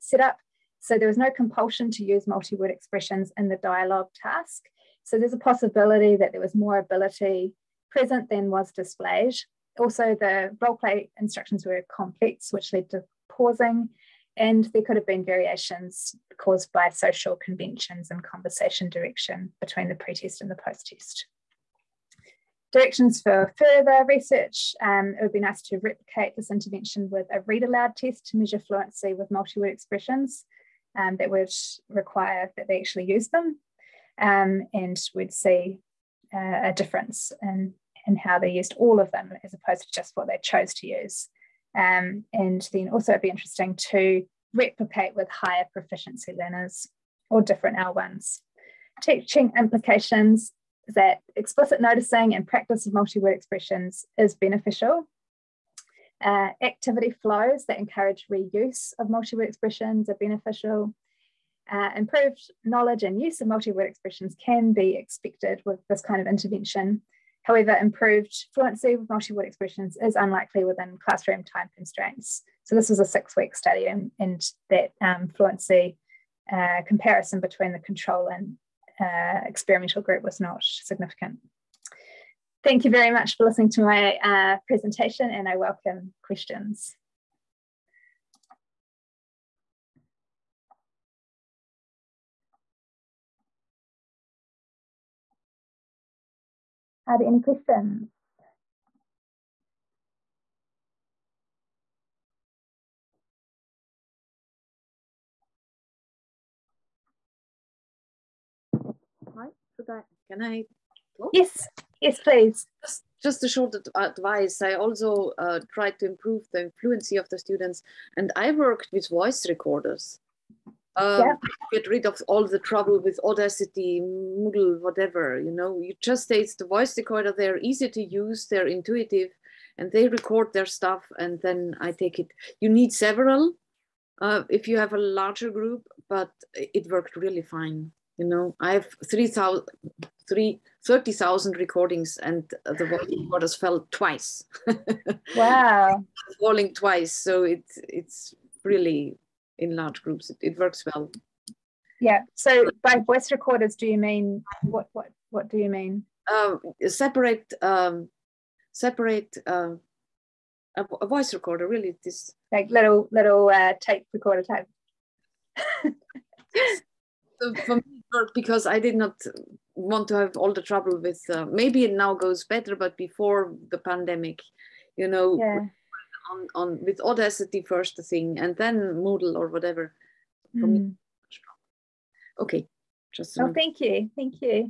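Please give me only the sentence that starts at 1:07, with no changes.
However, improved fluency with multi-word expressions is unlikely within classroom time constraints.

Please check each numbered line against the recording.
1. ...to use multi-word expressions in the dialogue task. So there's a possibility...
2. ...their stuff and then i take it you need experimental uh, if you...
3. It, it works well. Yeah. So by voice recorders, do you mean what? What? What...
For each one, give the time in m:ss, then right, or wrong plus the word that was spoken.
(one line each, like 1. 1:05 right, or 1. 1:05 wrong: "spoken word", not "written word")
1. 0:01 right
2. 2:10 wrong: "several", not "experimental"
3. 2:30 right.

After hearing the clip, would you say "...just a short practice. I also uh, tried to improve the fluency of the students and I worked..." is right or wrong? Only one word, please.
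wrong.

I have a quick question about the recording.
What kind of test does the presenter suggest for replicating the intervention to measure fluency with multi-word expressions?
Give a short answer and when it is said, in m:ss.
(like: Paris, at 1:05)
read aloud test, at 0:27.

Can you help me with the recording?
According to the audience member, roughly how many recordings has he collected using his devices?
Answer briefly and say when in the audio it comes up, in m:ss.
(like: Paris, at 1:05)
30,000, at 2:20.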